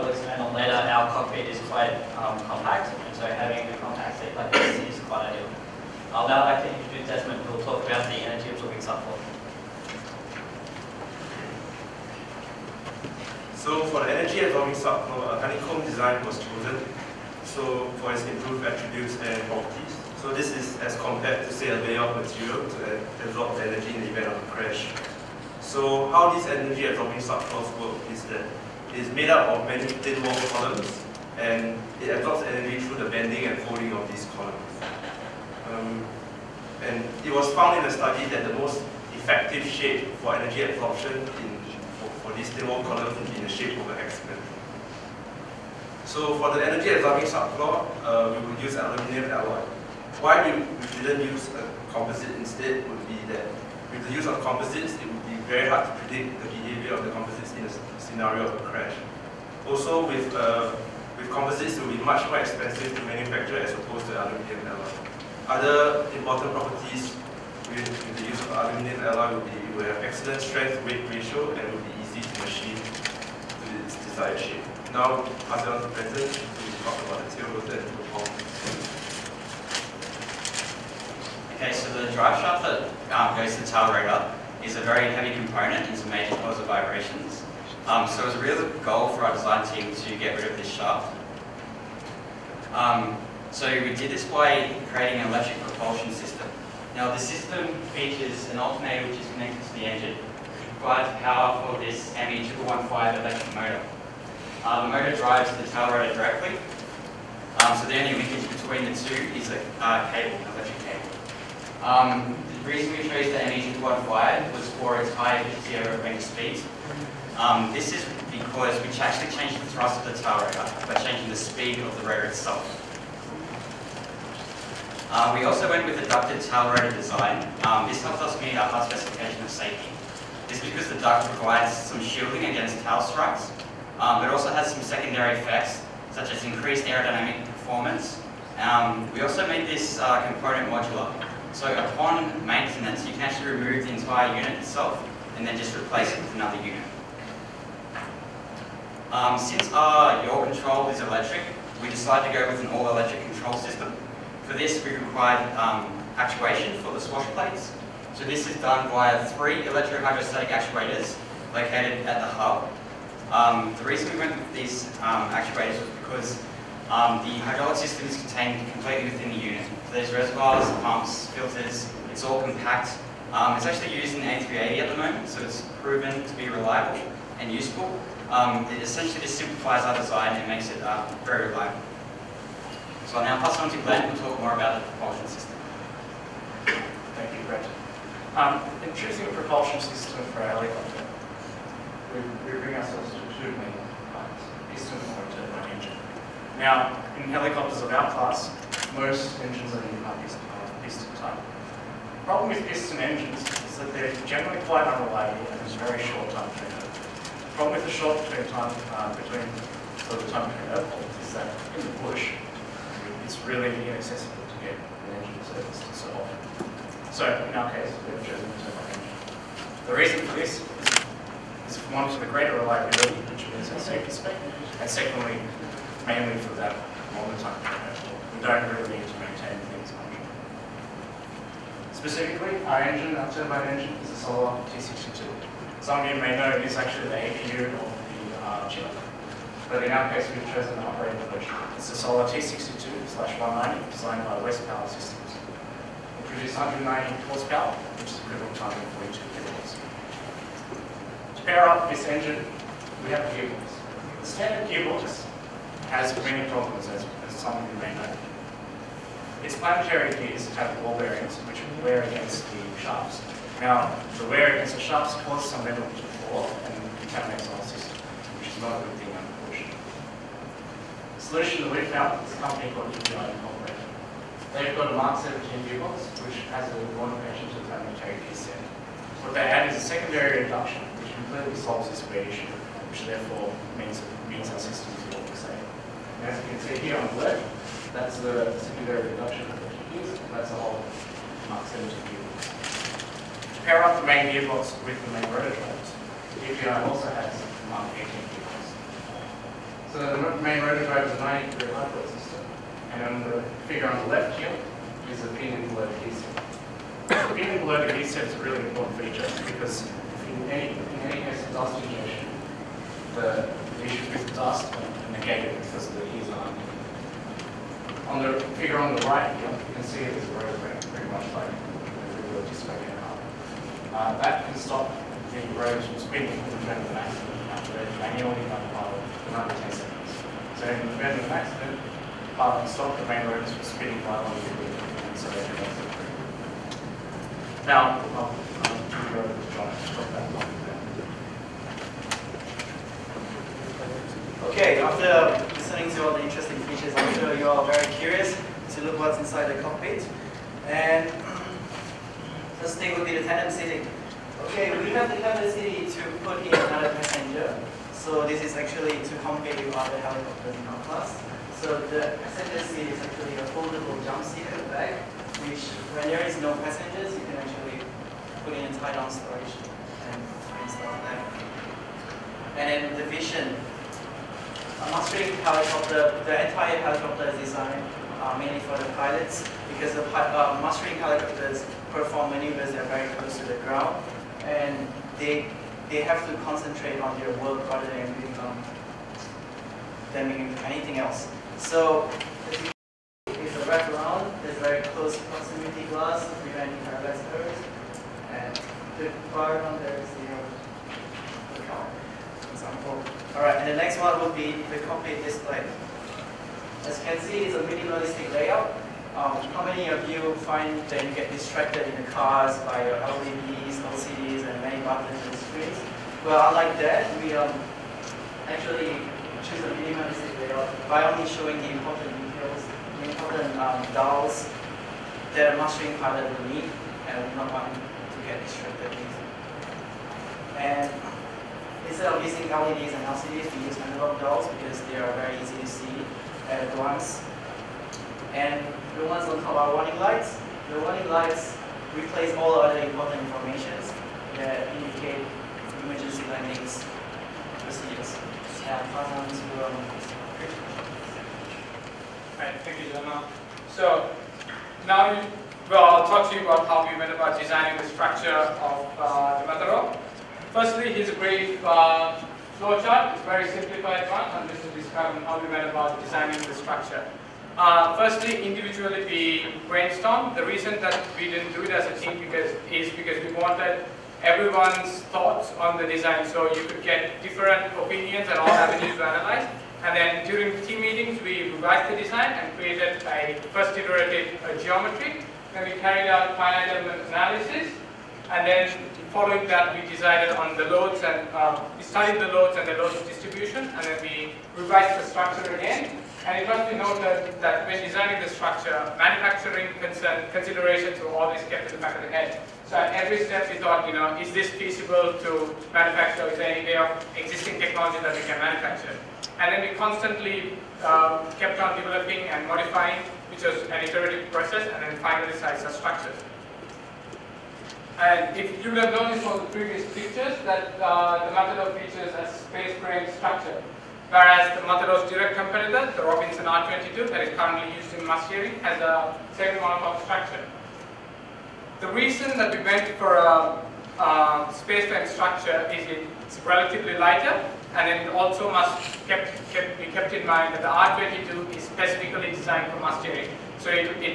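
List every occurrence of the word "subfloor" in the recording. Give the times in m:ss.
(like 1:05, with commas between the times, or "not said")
0:08, 0:14, 0:27, 0:47.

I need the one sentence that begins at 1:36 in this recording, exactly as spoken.
Now the system features an alternator which is connected to the engine, provides power for this ME215 electric motor.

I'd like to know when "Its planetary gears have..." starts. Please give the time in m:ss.
4:19.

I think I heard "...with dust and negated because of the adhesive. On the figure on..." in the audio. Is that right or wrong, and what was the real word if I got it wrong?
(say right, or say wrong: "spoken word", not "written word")
right.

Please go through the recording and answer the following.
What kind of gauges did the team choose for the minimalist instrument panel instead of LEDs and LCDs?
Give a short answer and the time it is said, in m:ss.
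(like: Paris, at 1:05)
analog dials, at 7:13.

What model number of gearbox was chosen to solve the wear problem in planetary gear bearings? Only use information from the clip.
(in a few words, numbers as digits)
Mark 17.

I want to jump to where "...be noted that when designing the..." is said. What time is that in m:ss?
8:16.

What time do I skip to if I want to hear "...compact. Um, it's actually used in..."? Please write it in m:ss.
2:52.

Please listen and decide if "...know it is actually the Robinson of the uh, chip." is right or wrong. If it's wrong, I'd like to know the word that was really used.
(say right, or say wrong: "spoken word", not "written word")
wrong: "APU", not "Robinson".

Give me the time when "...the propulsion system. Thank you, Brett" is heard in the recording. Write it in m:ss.
3:04.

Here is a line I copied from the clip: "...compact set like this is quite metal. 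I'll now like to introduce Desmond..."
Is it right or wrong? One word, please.
wrong.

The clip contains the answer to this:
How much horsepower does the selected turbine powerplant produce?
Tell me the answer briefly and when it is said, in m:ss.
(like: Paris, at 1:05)
190, at 4:06.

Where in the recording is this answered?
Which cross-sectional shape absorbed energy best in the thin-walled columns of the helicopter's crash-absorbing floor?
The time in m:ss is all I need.
0:43.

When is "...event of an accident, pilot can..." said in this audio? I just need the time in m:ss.
5:30.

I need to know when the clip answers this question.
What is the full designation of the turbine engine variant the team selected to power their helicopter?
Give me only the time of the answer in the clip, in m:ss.
4:01.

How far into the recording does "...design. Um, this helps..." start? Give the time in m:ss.
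2:06.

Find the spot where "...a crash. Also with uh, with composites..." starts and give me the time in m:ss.
0:58.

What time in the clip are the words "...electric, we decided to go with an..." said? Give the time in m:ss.
2:30.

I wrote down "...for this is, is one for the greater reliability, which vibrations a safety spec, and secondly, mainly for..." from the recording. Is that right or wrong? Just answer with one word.
wrong.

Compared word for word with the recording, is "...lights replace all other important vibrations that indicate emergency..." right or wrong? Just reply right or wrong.
wrong.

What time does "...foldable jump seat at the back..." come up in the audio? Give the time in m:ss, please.
6:03.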